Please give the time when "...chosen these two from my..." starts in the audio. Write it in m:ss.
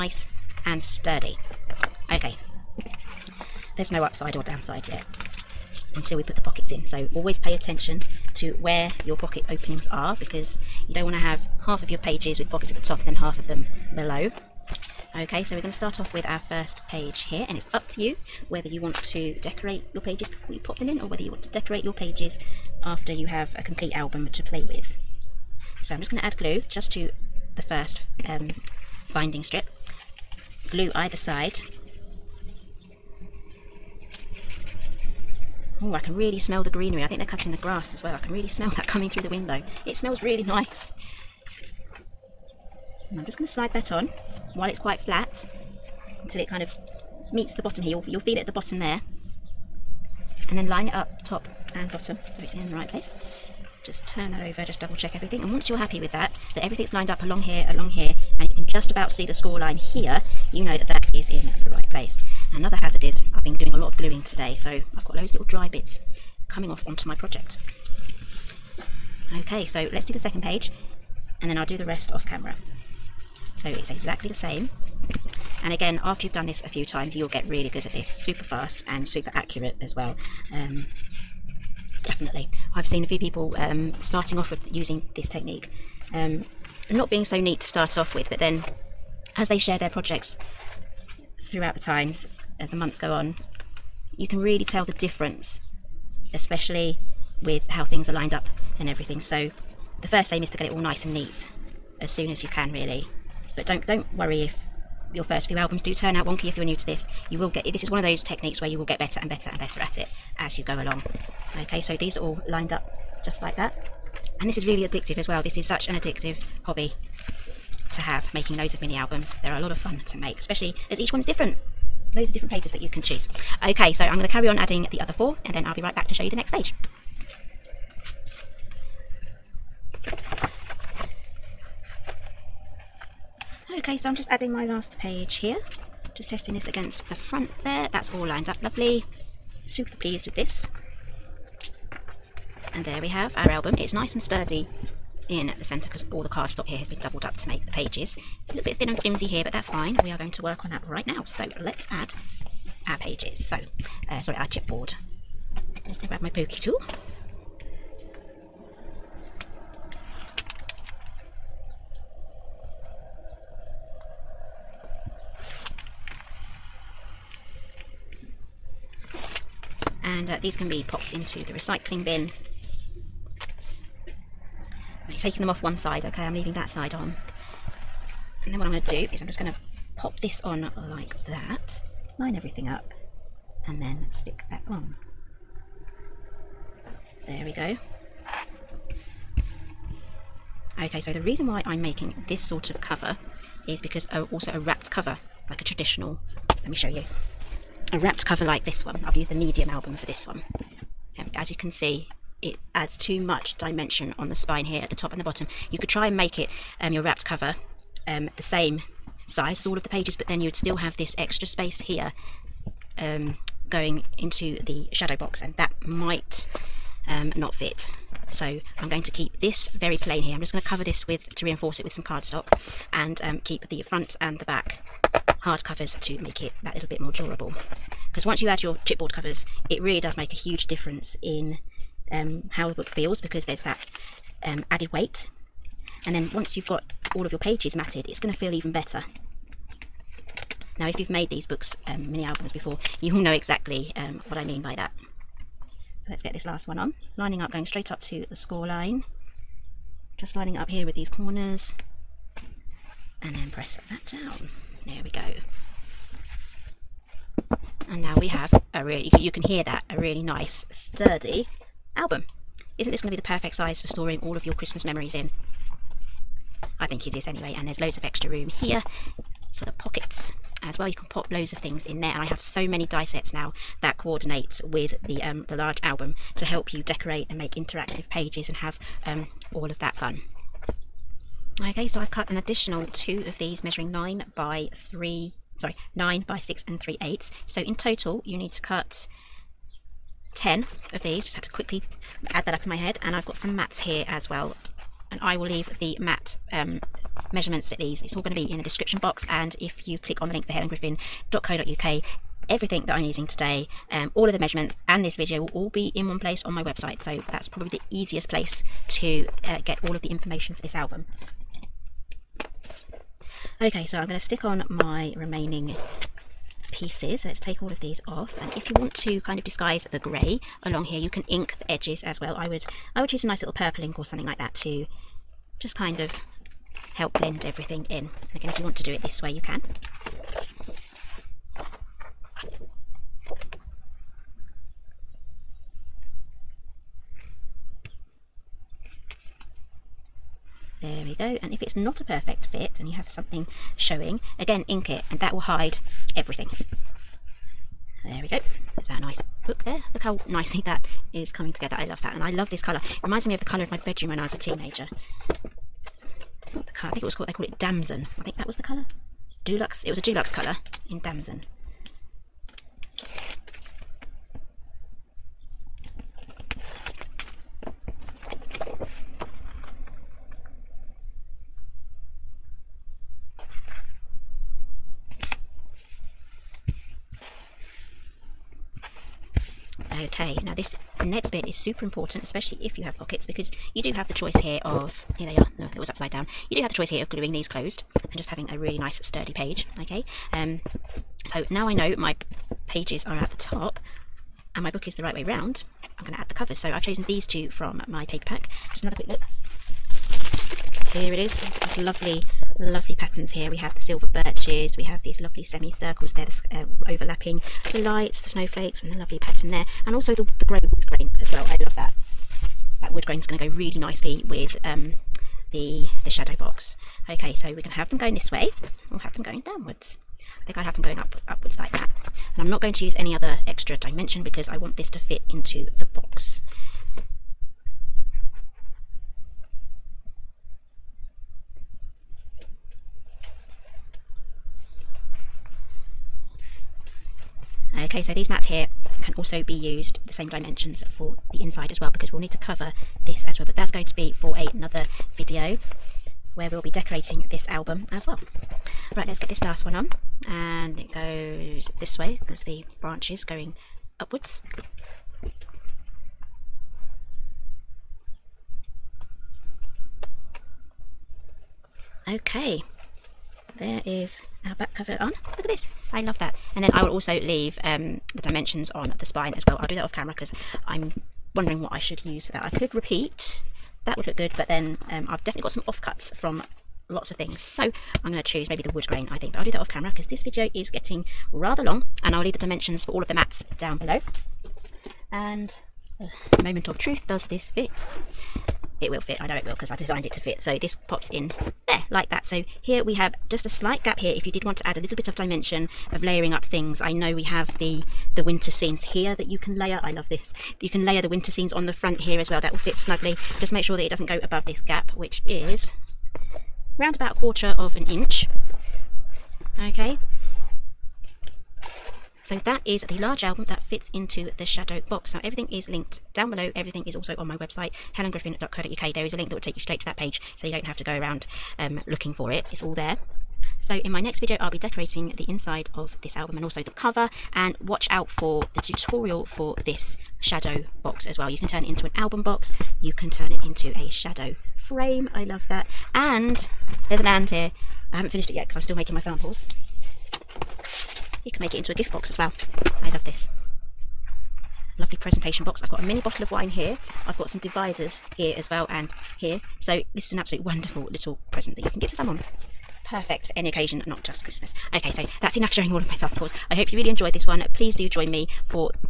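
6:36.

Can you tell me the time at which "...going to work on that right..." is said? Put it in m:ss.
2:30.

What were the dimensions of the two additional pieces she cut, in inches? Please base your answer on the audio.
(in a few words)
9 by 6 and 3/8.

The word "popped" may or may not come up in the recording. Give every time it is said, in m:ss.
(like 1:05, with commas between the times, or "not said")
2:50.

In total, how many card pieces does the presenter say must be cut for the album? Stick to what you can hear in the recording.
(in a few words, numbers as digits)
10.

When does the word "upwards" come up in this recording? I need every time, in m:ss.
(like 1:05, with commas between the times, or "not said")
7:01, 7:33.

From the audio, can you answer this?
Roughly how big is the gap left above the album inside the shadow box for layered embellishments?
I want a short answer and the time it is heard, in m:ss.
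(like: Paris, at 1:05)
A quarter of an inch, at 8:27.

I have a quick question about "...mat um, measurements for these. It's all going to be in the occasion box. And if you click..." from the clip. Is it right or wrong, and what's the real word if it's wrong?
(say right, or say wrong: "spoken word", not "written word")
wrong: "description", not "occasion".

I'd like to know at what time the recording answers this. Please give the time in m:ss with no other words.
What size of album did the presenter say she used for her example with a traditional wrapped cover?
3:19.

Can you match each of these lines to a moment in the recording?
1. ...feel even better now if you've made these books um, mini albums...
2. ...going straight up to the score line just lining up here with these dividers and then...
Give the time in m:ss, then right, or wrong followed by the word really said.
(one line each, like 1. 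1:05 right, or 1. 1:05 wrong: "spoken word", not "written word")
1. 3:58 right
2. 4:07 wrong: "corners", not "dividers".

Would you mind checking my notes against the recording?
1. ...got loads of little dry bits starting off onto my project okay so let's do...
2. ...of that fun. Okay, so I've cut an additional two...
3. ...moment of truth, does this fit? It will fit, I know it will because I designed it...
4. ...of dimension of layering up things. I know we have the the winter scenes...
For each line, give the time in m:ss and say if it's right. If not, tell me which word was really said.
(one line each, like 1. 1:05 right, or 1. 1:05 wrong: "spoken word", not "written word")
1. 1:05 wrong: "coming", not "starting"
2. 4:39 right
3. 8:06 right
4. 8:15 right.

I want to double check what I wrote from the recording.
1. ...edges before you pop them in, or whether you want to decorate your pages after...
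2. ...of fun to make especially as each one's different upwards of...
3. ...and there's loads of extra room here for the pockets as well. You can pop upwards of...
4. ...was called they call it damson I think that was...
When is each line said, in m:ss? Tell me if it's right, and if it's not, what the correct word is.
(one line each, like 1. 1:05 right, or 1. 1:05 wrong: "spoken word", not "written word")
1. 0:19 wrong: "pages", not "edges"
2. 1:59 wrong: "loads", not "upwards"
3. 4:27 wrong: "loads", not "upwards"
4. 5:57 right.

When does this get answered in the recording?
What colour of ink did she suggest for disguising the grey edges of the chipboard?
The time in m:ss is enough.
5:23.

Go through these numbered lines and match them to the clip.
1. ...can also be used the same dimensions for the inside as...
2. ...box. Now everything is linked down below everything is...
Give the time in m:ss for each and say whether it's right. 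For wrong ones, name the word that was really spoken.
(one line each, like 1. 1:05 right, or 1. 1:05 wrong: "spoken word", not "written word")
1. 7:19 right
2. 8:34 right.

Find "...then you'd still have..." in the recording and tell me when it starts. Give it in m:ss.
3:30.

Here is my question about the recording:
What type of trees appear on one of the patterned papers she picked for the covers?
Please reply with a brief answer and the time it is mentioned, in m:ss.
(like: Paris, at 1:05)
Silver birches, at 6:43.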